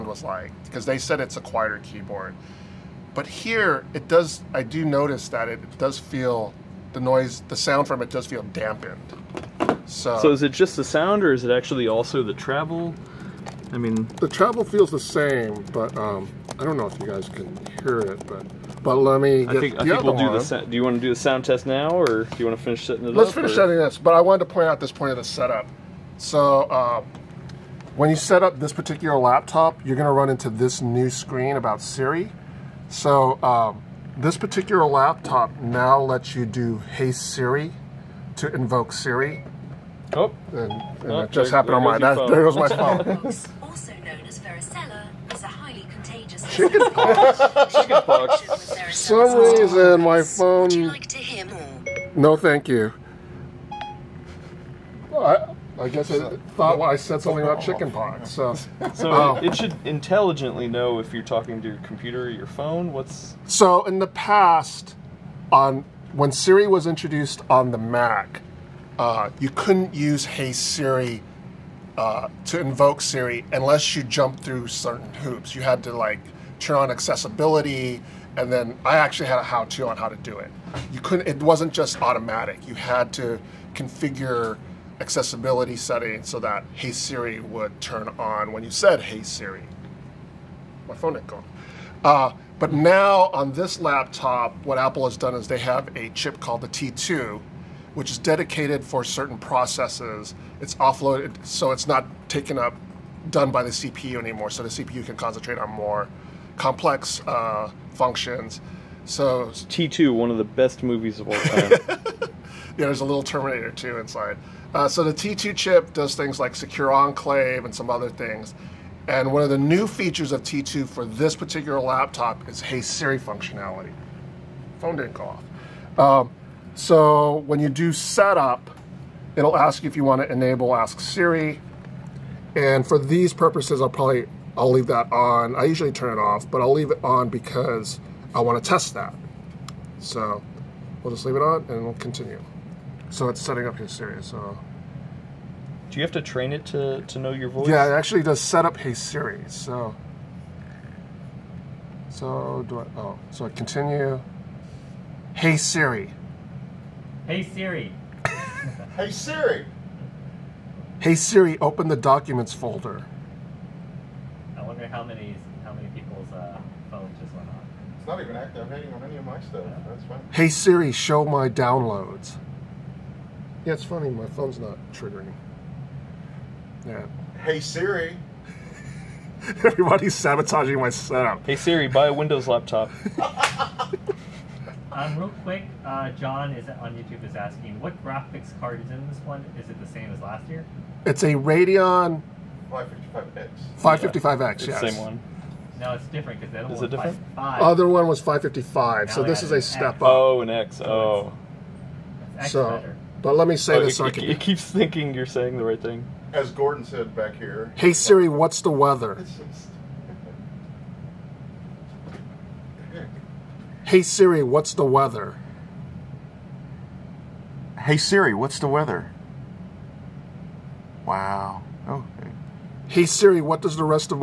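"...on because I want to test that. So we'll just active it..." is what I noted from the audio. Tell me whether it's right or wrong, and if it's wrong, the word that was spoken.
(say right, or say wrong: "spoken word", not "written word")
wrong: "leave", not "active".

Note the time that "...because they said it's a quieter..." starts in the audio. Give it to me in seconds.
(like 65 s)
0 s.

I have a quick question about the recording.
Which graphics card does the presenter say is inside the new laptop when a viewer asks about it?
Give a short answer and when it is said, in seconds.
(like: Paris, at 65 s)
Radeon 555X, at 191 s.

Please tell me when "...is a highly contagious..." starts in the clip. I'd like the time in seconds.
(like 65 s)
45 s.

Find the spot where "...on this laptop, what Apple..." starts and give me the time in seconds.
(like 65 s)
93 s.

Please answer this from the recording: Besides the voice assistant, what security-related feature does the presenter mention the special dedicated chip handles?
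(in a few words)
secure enclave.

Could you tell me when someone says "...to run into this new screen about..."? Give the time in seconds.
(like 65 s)
30 s.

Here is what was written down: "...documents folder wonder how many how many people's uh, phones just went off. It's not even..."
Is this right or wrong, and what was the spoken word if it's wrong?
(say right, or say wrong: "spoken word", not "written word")
right.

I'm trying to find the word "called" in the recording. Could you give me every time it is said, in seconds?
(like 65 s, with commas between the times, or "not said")
96 s.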